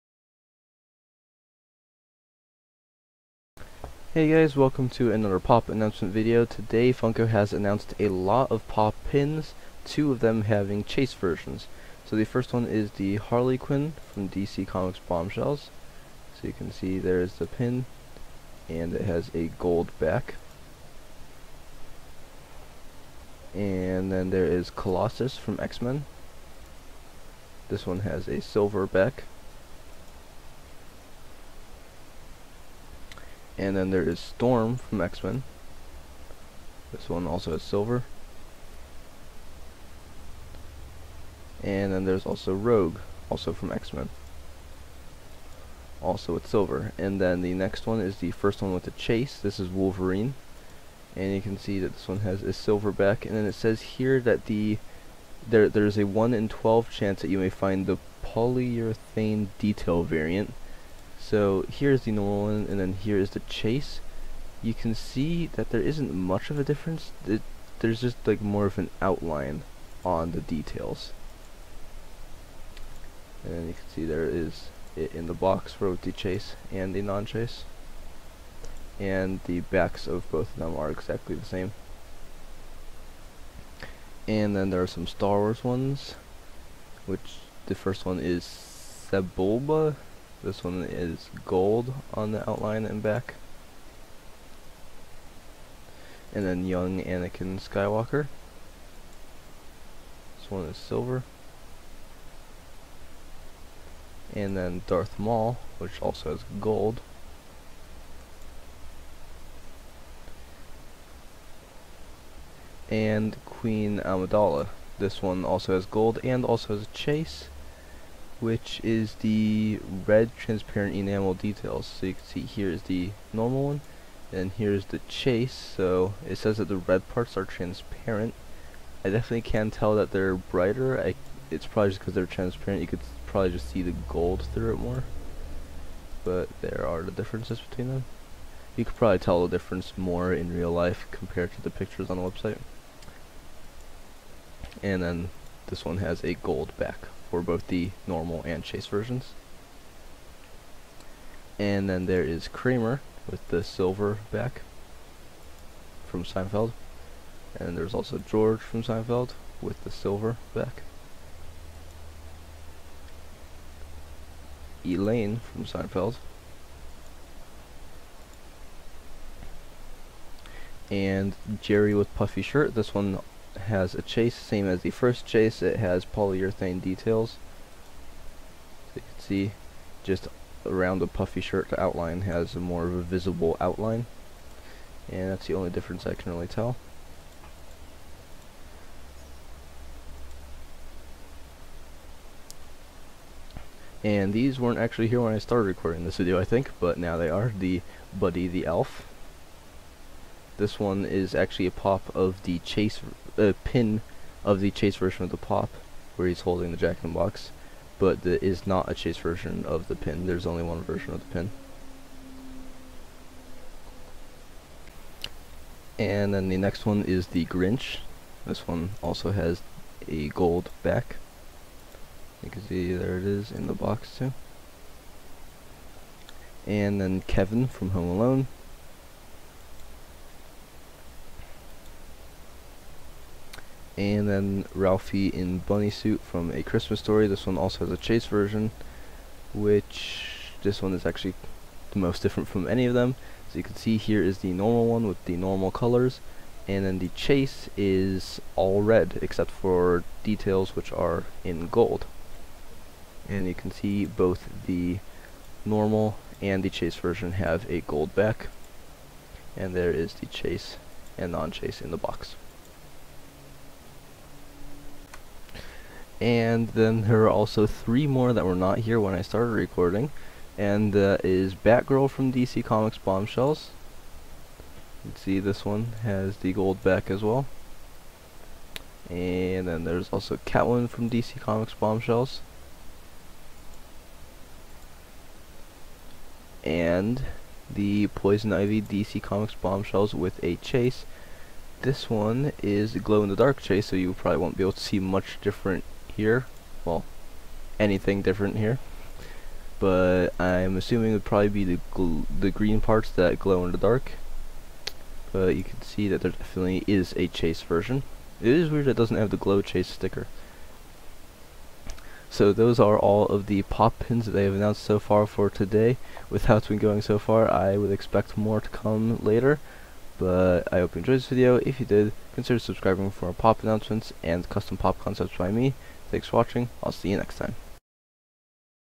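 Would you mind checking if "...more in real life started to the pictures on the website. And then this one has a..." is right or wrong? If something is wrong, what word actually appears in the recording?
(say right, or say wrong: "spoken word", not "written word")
wrong: "compared", not "started".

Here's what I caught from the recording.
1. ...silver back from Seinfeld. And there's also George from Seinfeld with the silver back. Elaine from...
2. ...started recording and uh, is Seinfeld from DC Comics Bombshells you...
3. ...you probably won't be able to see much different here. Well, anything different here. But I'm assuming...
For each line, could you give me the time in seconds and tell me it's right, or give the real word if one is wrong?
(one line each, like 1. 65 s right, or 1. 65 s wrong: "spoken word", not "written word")
1. 153 s right
2. 269 s wrong: "Batgirl", not "Seinfeld"
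3. 293 s right.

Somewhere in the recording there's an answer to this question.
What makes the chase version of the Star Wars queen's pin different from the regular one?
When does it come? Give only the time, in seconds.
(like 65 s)
120 s.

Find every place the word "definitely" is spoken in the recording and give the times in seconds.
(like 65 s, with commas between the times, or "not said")
129 s, 306 s.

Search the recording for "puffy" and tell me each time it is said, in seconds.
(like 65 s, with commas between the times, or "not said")
172 s, 181 s.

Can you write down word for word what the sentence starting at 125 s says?
So it says that the red parts are transparent.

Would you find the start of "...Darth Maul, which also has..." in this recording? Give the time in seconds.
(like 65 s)
104 s.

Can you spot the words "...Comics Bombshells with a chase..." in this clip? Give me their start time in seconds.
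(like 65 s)
289 s.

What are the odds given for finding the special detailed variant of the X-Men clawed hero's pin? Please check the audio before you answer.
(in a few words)
1 in 12.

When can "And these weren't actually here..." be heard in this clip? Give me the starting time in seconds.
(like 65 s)
194 s.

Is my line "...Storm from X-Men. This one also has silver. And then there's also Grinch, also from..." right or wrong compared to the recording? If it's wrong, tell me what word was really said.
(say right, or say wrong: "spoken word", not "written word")
wrong: "Rogue", not "Grinch".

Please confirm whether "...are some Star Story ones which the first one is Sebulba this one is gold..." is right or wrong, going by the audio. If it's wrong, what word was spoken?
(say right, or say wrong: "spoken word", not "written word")
wrong: "Wars", not "Story".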